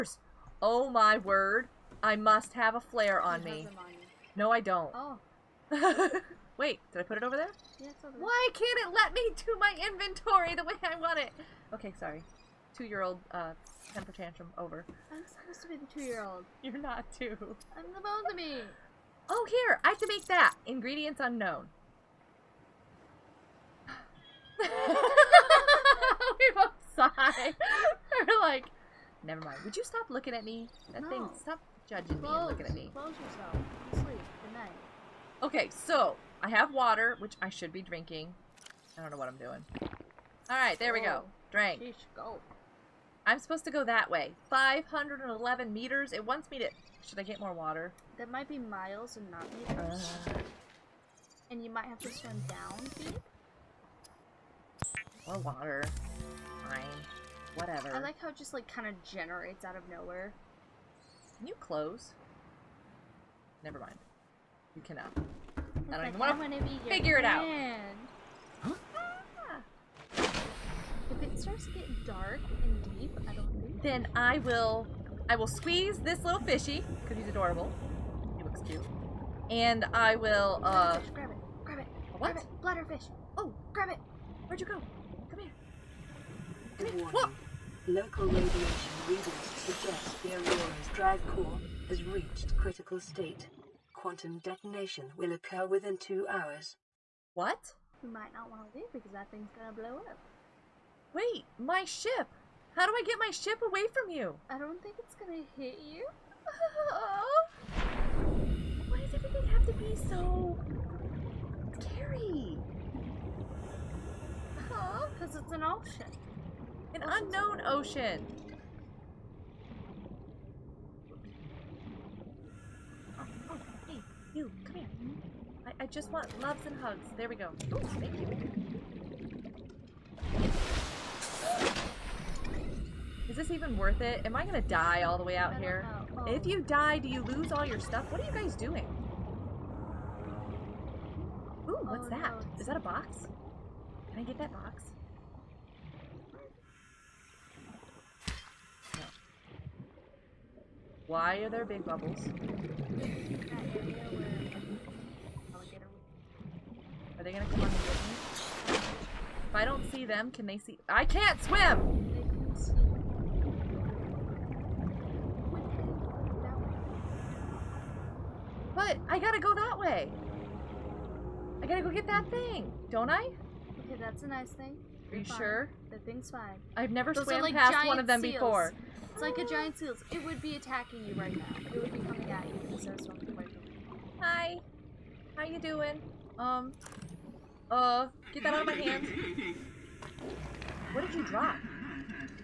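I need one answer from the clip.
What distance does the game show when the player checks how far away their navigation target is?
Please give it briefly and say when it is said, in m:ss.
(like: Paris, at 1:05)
511 meters, at 0:44.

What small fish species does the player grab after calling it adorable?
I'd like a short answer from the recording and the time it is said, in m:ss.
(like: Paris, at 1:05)
Bladderfish, at 1:22.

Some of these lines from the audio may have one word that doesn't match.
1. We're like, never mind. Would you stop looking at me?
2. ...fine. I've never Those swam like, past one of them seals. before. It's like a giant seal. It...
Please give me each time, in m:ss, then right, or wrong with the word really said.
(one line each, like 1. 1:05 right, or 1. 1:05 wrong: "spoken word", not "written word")
1. 0:28 right
2. 2:56 right.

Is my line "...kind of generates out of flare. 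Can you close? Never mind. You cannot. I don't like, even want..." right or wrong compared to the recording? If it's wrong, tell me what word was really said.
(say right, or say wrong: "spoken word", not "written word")
wrong: "nowhere", not "flare".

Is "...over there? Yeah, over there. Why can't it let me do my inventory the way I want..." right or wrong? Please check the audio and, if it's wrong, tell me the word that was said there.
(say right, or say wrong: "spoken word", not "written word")
right.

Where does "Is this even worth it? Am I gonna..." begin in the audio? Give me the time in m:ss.
2:13.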